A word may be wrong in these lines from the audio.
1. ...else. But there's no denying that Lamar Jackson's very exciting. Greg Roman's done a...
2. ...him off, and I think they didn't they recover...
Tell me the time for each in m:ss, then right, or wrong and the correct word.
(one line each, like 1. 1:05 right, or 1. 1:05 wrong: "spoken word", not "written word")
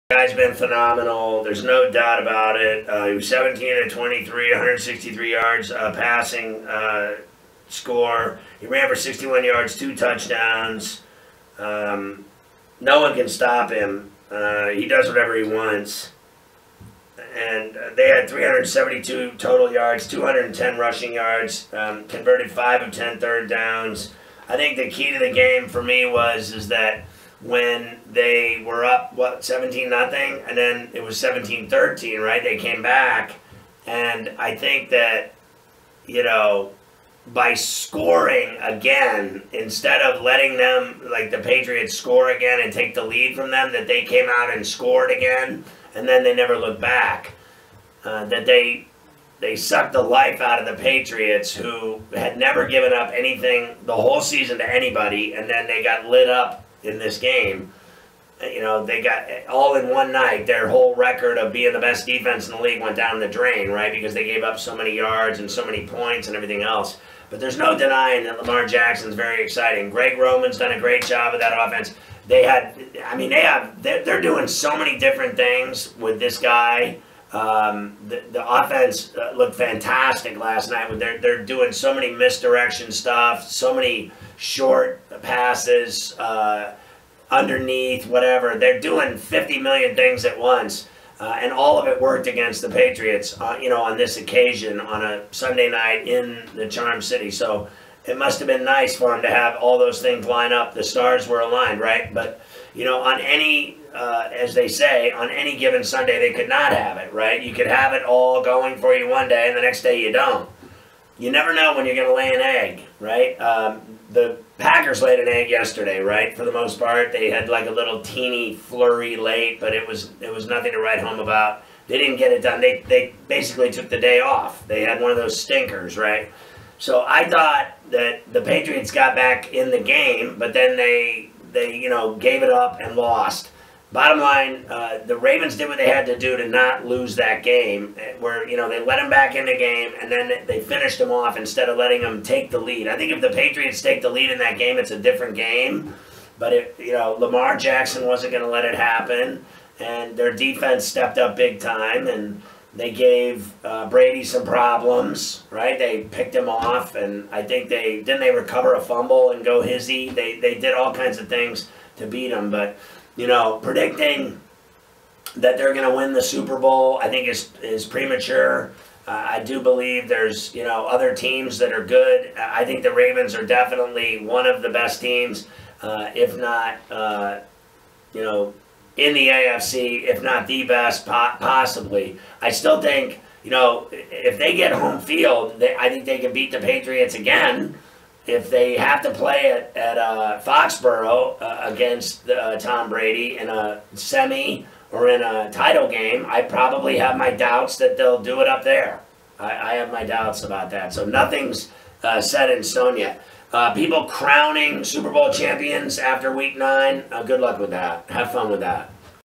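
1. 1:06 right
2. 2:36 right.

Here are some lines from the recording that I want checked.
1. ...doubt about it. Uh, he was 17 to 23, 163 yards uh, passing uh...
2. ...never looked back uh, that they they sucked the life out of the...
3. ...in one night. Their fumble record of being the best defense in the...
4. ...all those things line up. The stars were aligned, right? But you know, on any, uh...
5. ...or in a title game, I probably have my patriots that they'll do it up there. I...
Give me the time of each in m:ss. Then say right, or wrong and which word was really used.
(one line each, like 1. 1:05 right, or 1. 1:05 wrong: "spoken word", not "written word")
1. 0:01 right
2. 0:46 right
3. 0:59 wrong: "whole", not "fumble"
4. 1:39 right
5. 3:14 wrong: "doubts", not "patriots".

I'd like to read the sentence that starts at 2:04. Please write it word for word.
They had one of those stinkers, right?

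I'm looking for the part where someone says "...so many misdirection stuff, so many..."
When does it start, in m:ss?
1:21.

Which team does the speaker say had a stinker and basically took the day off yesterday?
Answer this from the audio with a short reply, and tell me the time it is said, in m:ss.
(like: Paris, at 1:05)
The Packers, at 1:54.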